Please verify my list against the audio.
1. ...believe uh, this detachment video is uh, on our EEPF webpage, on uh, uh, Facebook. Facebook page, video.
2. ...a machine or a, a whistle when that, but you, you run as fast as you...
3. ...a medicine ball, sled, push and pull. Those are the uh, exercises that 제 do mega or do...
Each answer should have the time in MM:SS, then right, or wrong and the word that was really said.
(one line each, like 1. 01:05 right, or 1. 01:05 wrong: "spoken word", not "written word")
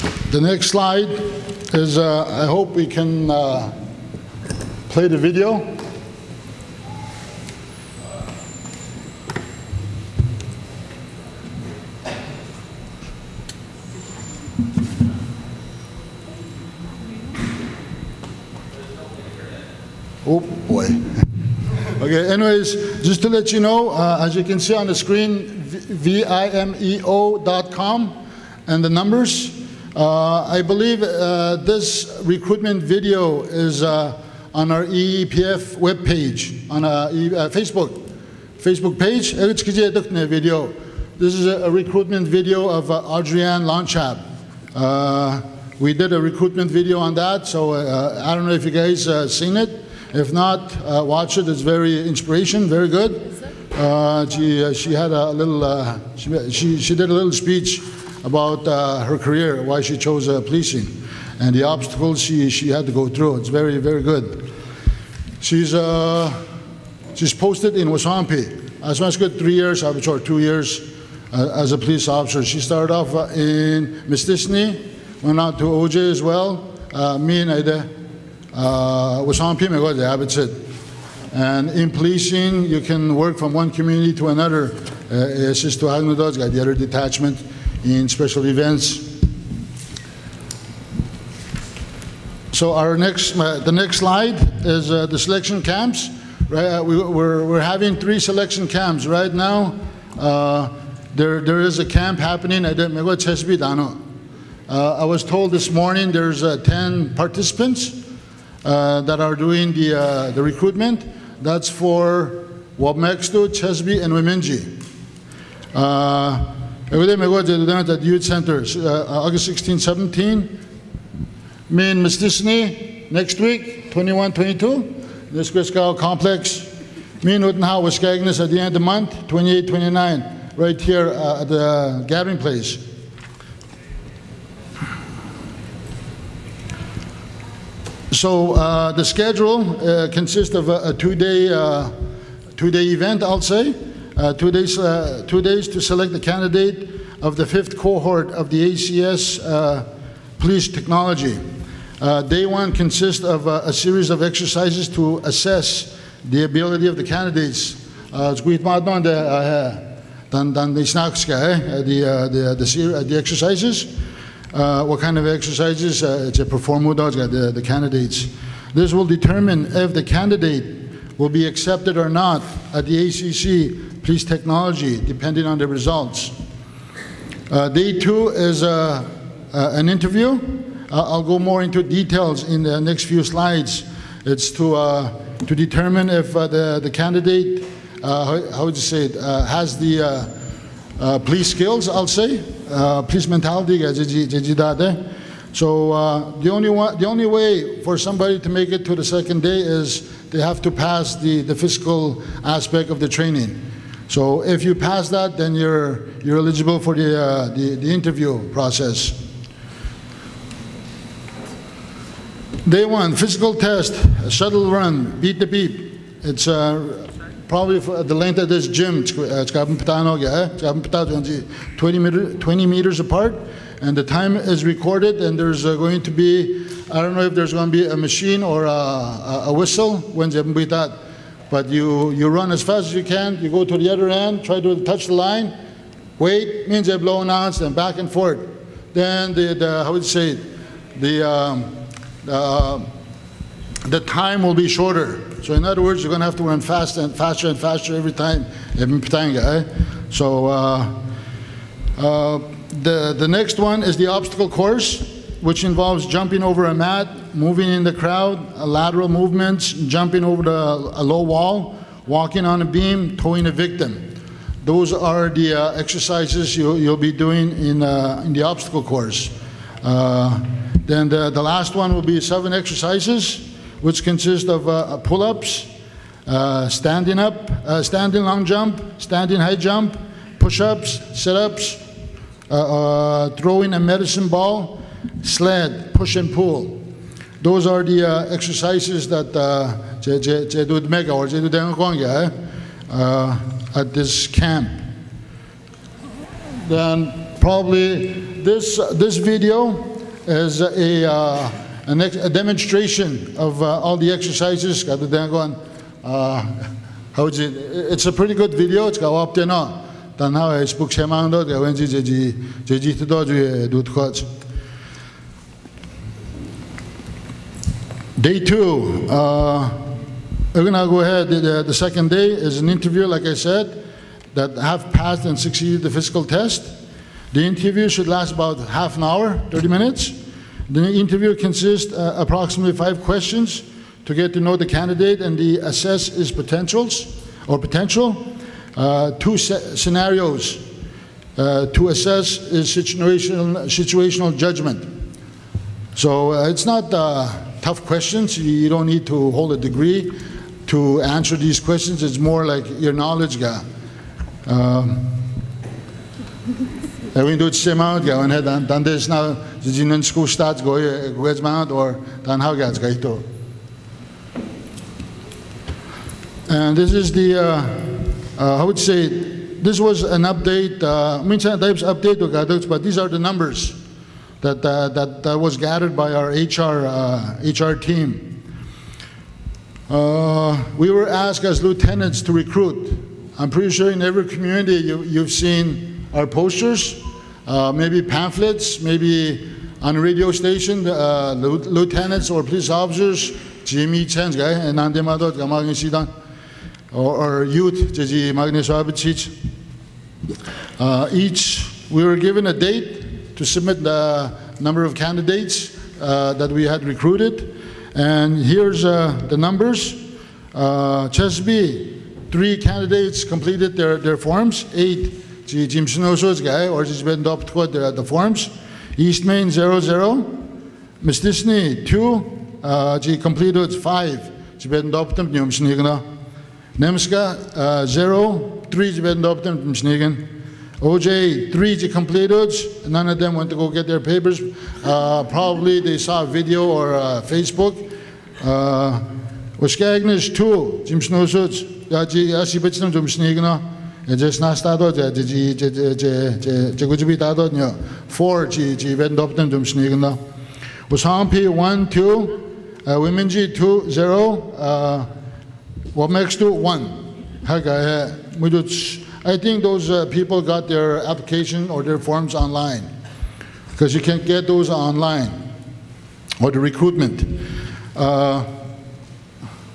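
1. 00:30 wrong: "recruitment", not "detachment"
2. 03:47 right
3. 04:43 right.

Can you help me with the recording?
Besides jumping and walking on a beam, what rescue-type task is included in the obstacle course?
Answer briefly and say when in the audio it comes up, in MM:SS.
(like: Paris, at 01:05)
towing a victim, at 04:23.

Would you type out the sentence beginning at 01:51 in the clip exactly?
That's for Wabmextu, Chesby, and Wemindji.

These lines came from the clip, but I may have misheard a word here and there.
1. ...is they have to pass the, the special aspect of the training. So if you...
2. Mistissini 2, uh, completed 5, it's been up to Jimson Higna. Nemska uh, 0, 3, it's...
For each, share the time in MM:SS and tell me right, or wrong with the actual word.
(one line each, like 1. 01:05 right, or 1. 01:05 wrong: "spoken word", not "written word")
1. 03:19 wrong: "physical", not "special"
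2. 07:01 right.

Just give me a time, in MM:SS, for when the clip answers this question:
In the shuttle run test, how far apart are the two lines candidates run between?
03:42.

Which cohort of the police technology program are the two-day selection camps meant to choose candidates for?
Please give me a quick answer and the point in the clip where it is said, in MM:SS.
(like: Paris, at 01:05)
fifth, at 02:27.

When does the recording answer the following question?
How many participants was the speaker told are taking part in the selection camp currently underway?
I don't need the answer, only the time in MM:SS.
01:46.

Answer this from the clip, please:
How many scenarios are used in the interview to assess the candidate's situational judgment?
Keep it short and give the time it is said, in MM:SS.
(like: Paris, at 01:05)
2, at 05:39.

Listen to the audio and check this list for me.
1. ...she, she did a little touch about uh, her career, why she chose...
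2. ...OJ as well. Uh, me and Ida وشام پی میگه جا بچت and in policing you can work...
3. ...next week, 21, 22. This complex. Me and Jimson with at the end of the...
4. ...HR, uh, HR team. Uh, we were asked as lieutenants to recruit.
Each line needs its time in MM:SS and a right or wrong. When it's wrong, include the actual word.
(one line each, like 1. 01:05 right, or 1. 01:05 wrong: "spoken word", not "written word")
1. 00:56 wrong: "speech", not "touch"
2. 01:15 right
3. 02:03 wrong: "Utenhow", not "Jimson"
4. 06:16 right.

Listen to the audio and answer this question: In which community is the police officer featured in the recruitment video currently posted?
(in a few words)
Wasampi.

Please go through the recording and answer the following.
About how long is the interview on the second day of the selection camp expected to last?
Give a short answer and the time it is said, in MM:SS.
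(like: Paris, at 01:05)
30 minutes, at 05:29.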